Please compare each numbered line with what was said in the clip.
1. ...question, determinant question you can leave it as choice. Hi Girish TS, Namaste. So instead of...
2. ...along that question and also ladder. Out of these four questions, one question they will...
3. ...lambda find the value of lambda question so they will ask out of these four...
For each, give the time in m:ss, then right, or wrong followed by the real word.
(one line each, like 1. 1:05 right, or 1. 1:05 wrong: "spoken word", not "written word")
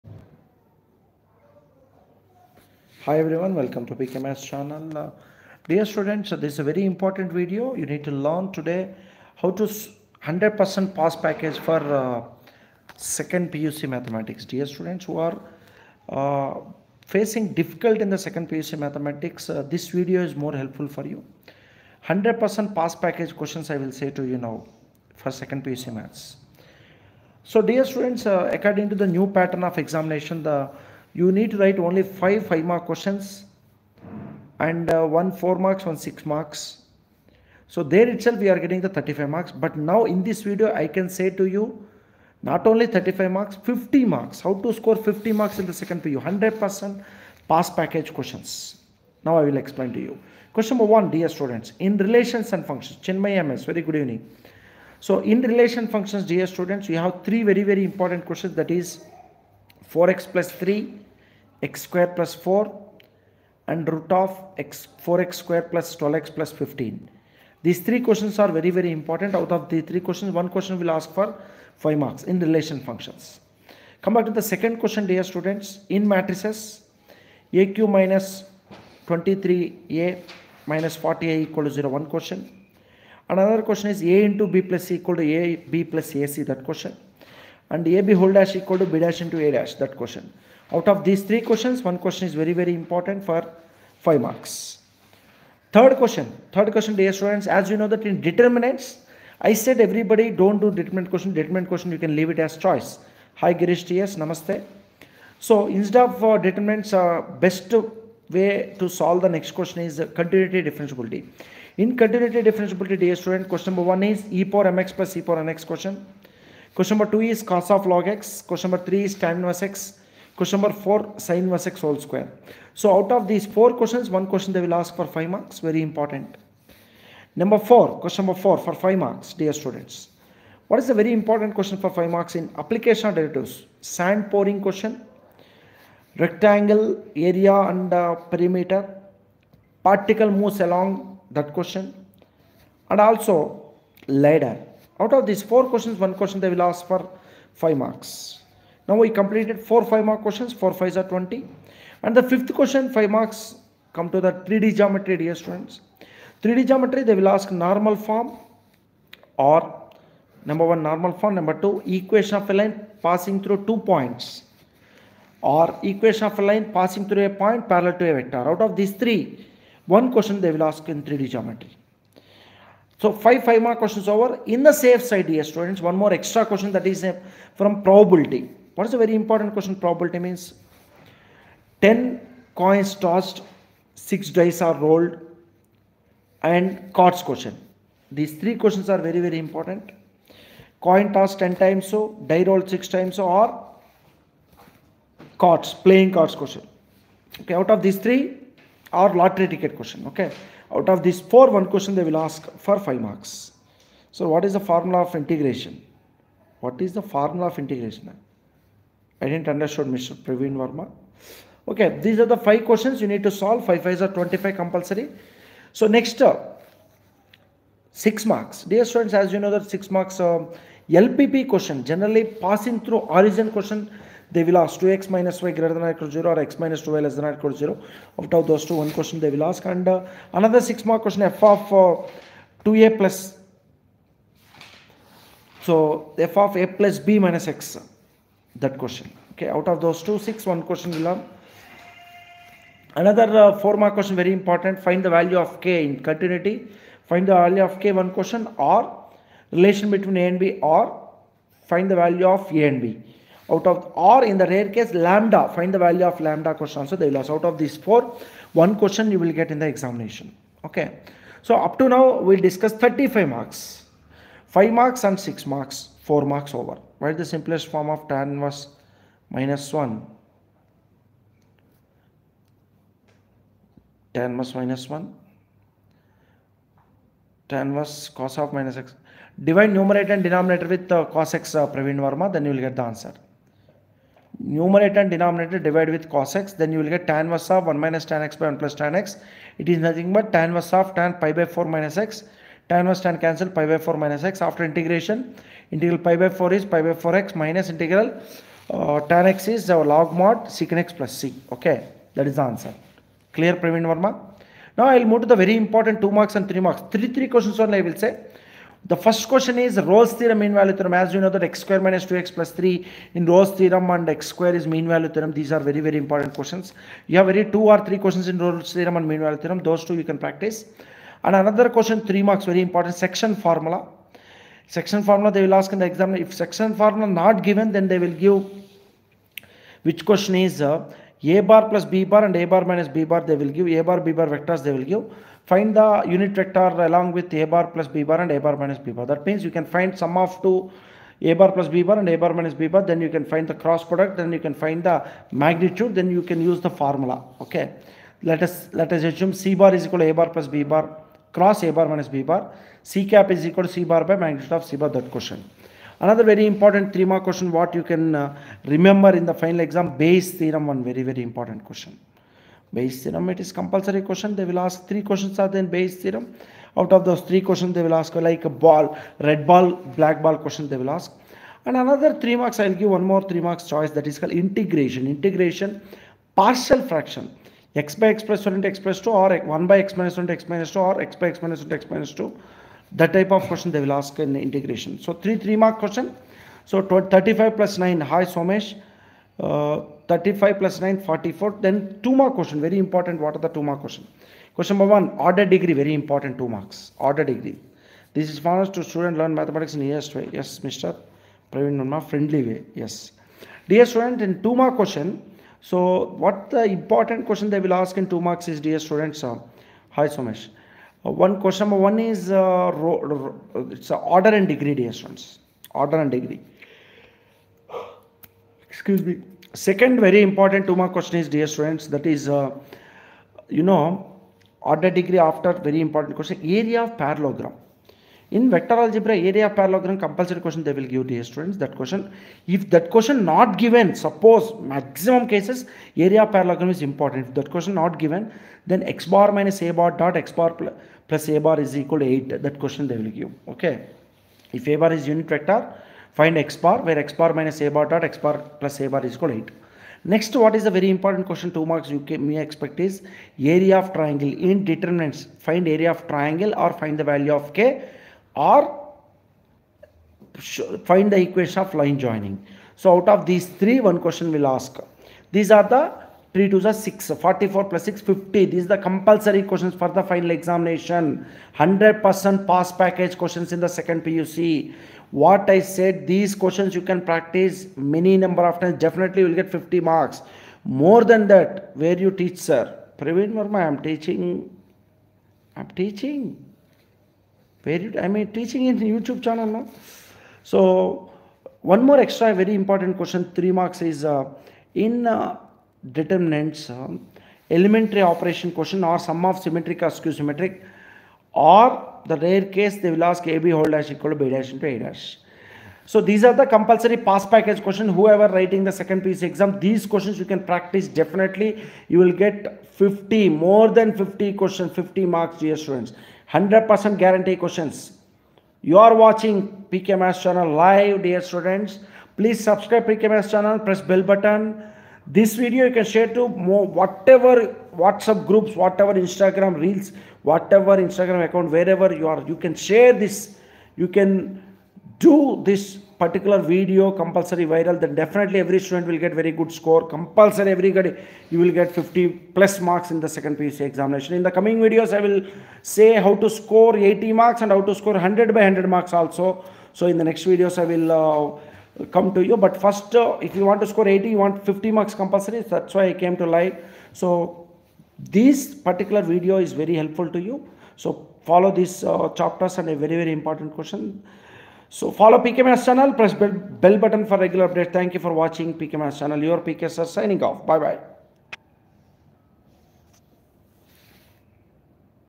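1. 1:41 right
2. 2:20 right
3. 4:14 right.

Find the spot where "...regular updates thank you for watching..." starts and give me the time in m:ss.
9:27.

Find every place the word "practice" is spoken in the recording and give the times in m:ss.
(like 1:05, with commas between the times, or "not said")
5:20, 7:57, 8:30.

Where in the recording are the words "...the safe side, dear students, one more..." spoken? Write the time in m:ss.
2:54.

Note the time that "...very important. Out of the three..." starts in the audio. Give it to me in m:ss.
1:08.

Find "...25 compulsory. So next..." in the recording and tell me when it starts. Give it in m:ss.
3:34.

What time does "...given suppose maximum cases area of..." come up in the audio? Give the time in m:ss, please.
7:13.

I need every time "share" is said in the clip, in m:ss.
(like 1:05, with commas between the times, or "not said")
8:45, 8:52.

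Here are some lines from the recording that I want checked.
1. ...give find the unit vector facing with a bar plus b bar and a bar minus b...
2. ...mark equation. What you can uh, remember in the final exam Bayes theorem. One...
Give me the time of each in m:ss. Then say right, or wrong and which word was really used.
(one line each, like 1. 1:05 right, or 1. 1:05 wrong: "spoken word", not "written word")
1. 5:34 wrong: "along", not "facing"
2. 5:57 wrong: "question", not "equation".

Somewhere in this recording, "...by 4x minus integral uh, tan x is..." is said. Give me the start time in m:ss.
4:56.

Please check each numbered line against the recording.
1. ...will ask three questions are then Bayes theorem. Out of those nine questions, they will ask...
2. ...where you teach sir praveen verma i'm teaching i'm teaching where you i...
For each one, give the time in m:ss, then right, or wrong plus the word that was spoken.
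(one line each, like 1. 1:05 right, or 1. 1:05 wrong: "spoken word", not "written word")
1. 6:04 wrong: "three", not "nine"
2. 8:01 right.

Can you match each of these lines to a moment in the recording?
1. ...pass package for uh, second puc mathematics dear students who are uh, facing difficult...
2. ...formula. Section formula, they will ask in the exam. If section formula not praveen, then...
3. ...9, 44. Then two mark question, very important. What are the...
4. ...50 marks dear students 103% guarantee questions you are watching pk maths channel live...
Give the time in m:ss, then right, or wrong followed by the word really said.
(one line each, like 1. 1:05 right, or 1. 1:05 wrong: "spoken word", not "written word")
1. 0:10 right
2. 5:23 wrong: "given", not "praveen"
3. 6:30 right
4. 8:34 wrong: "100", not "103".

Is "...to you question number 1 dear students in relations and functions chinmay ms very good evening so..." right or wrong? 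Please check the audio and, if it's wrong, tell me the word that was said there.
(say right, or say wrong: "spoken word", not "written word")
right.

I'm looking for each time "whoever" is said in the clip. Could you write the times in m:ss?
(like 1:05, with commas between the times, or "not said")
8:27.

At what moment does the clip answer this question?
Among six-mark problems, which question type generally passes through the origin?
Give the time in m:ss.
3:40.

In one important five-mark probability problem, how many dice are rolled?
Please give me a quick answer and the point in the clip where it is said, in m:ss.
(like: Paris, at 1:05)
6, at 3:03.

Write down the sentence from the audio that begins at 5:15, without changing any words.
These are very, very important questions.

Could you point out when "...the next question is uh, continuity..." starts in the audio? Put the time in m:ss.
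1:49.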